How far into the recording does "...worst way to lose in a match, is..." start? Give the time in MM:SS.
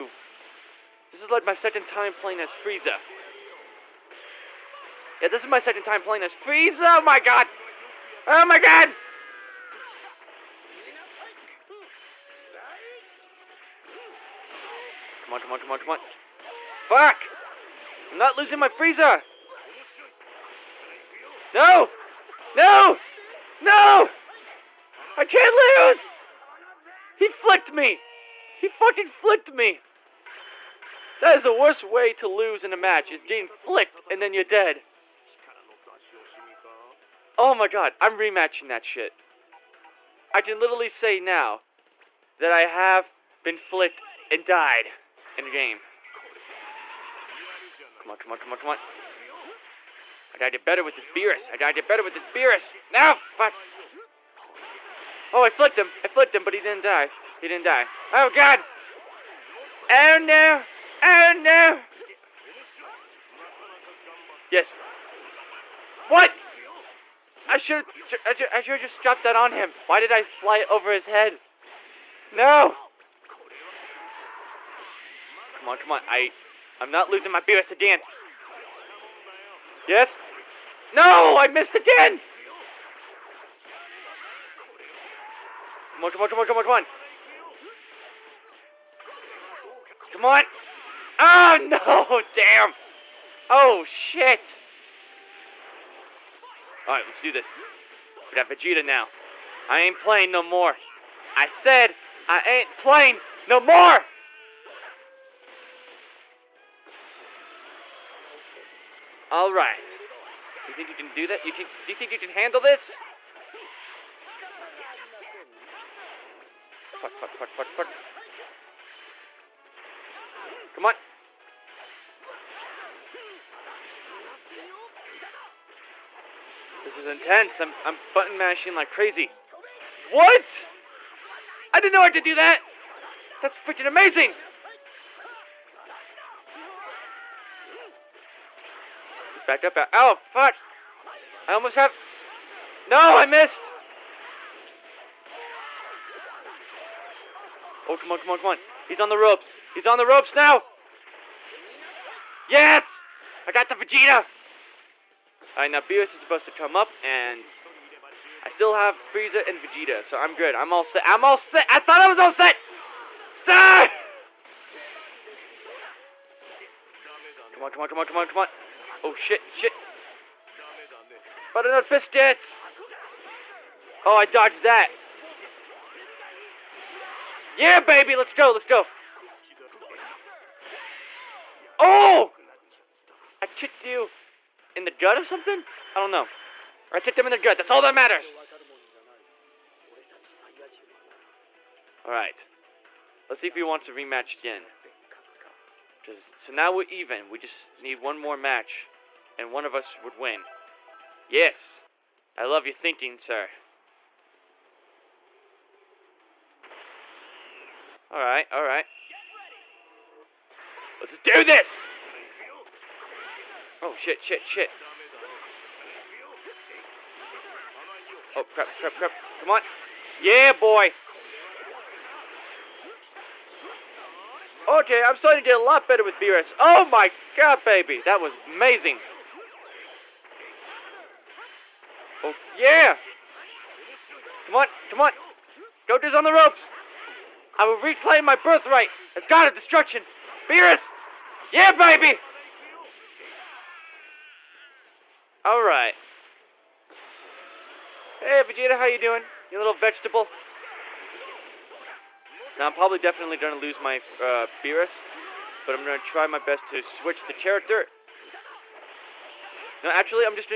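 00:31.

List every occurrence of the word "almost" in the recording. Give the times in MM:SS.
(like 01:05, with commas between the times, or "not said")
02:21.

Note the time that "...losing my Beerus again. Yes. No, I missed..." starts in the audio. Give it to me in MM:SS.
01:17.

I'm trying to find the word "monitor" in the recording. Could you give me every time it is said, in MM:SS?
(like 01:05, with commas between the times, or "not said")
not said.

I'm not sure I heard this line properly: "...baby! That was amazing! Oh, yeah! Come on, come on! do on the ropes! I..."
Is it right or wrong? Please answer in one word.
right.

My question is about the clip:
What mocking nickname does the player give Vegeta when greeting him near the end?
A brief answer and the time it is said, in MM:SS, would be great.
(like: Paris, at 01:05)
little vegetable, at 04:09.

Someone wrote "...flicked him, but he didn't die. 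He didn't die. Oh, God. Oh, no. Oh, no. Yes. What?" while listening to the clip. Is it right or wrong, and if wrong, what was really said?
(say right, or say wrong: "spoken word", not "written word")
right.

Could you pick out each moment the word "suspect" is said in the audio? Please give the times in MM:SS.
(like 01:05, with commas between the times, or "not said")
not said.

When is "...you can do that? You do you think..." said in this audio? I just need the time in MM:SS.
01:50.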